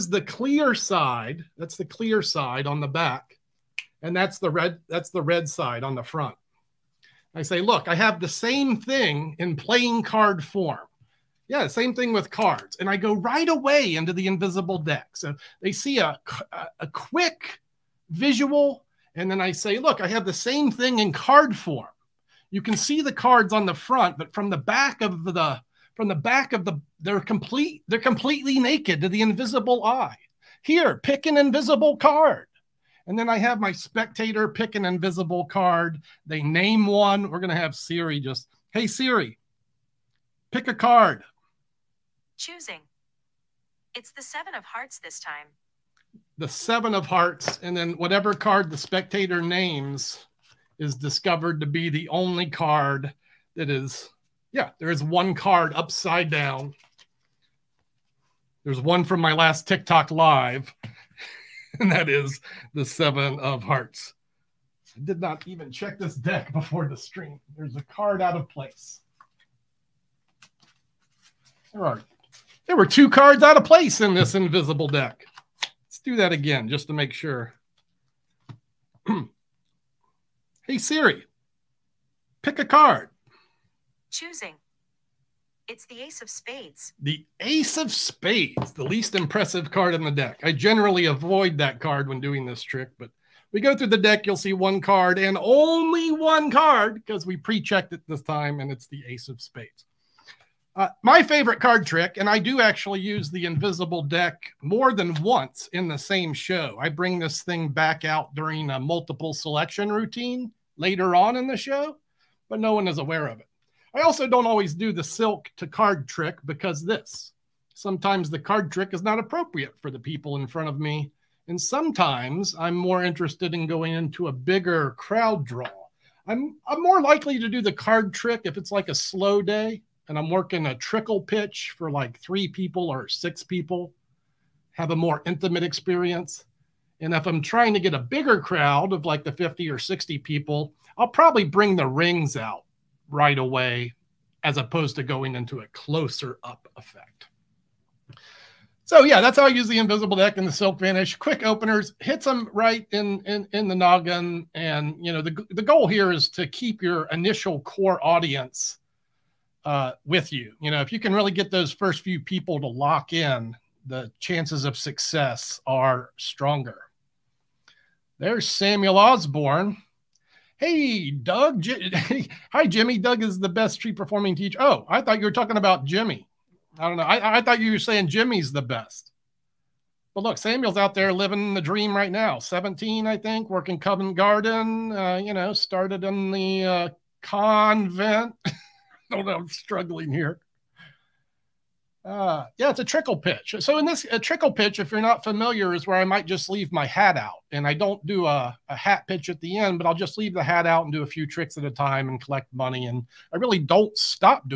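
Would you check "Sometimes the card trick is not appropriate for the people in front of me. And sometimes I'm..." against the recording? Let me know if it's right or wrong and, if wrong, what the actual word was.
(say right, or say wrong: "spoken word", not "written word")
right.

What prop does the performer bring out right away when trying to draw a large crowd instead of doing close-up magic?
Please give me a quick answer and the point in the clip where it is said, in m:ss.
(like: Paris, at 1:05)
the rings, at 2:21.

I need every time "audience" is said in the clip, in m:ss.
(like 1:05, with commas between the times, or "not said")
2:38.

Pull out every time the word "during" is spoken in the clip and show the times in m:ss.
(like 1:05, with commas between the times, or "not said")
1:48.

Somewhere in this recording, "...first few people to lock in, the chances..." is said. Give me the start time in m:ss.
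2:41.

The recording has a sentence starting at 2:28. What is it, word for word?
So yeah, that's how I use the invisible deck and the silk vanish.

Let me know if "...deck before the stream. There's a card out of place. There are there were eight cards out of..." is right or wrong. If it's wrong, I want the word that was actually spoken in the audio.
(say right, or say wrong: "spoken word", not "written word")
wrong: "two", not "eight".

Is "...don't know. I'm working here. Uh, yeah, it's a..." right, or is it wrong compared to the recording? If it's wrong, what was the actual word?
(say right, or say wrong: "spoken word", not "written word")
wrong: "struggling", not "working".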